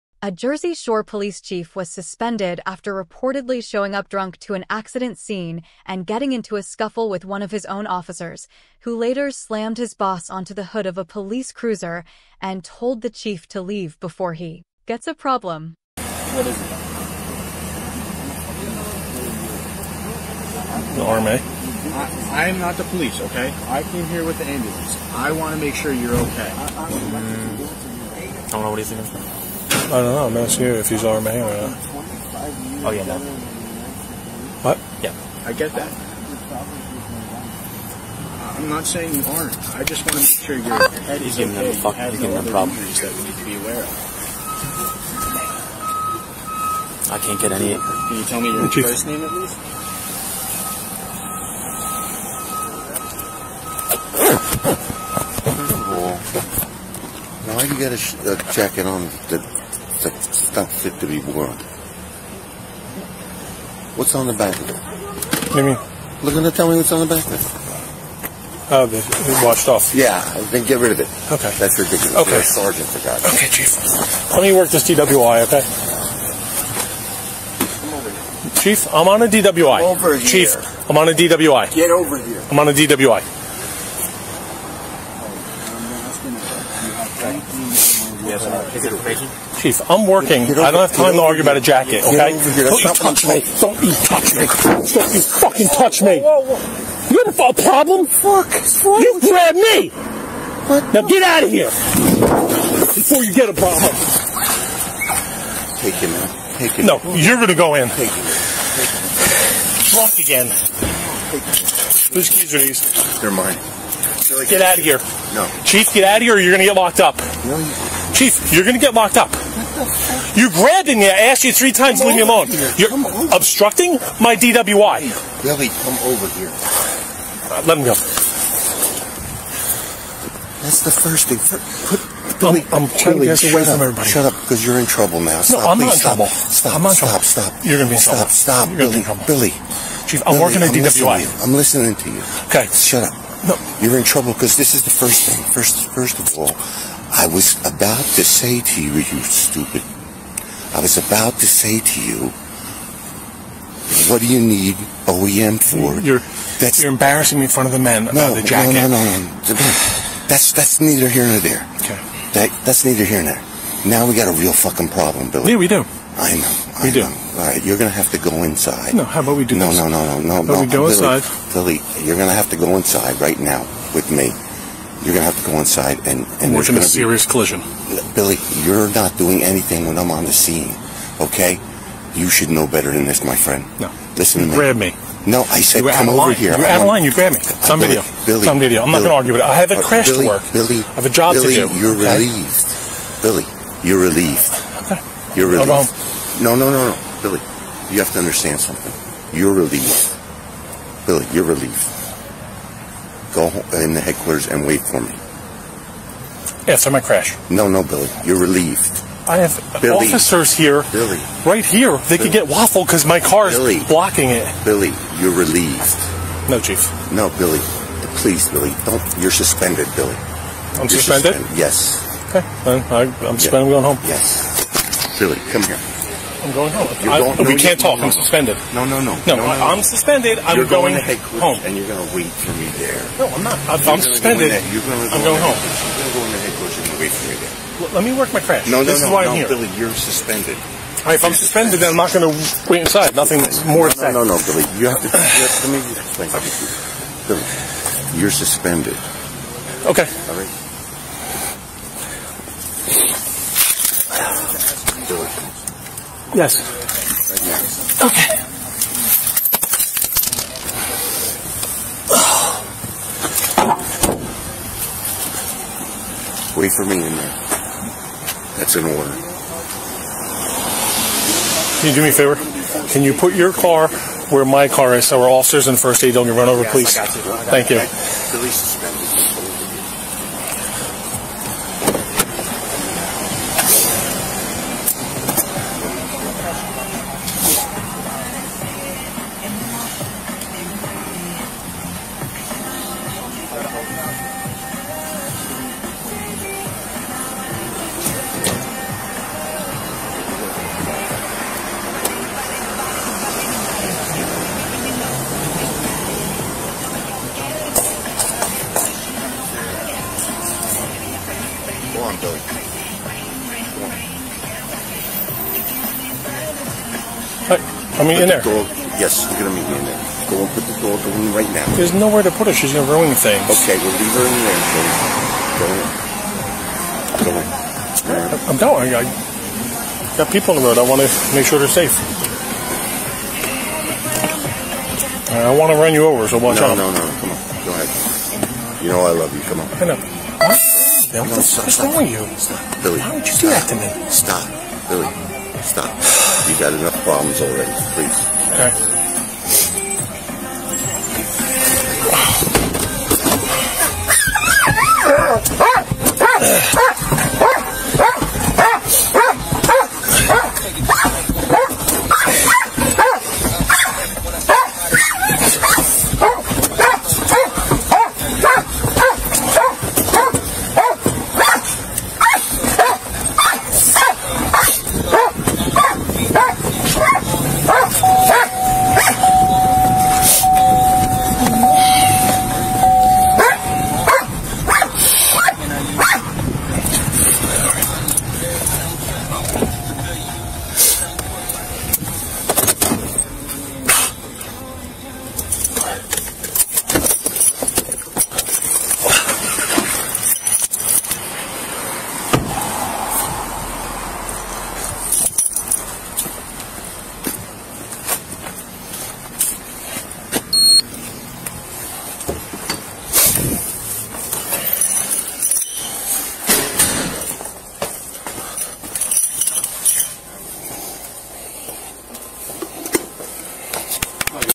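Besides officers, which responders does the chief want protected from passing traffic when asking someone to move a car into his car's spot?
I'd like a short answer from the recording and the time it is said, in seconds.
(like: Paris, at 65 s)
First aid, at 275 s.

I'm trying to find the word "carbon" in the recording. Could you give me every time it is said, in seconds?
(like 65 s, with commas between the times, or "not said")
not said.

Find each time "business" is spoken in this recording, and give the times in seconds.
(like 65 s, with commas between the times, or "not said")
not said.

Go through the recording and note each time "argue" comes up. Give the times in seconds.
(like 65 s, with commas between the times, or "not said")
91 s, 189 s.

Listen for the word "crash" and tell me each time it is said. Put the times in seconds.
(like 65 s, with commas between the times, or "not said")
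189 s, 207 s, 238 s.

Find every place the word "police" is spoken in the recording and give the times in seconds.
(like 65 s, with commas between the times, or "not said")
1 s, 11 s, 22 s.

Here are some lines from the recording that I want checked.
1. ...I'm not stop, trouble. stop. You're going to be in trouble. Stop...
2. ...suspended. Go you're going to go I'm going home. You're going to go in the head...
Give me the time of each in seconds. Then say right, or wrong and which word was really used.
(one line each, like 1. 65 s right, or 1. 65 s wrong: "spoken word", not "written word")
1. 136 s right
2. 234 s right.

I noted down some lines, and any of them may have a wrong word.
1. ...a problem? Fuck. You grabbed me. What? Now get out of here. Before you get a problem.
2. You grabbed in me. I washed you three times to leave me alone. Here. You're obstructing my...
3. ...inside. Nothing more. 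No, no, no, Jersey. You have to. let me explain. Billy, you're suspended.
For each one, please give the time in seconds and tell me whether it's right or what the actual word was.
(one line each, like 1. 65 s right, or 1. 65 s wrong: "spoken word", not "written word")
1. 97 s right
2. 120 s wrong: "asked", not "washed"
3. 242 s wrong: "Billy", not "Jersey".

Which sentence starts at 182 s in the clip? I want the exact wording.
You should know better than this, my friend.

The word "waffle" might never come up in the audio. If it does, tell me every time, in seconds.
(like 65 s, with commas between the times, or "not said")
212 s.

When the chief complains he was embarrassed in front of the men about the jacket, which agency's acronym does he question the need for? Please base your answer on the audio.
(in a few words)
OEM.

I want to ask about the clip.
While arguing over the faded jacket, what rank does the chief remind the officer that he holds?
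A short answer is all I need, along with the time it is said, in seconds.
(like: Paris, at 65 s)
Sergeant, at 72 s.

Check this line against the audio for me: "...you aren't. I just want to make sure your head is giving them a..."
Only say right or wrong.
right.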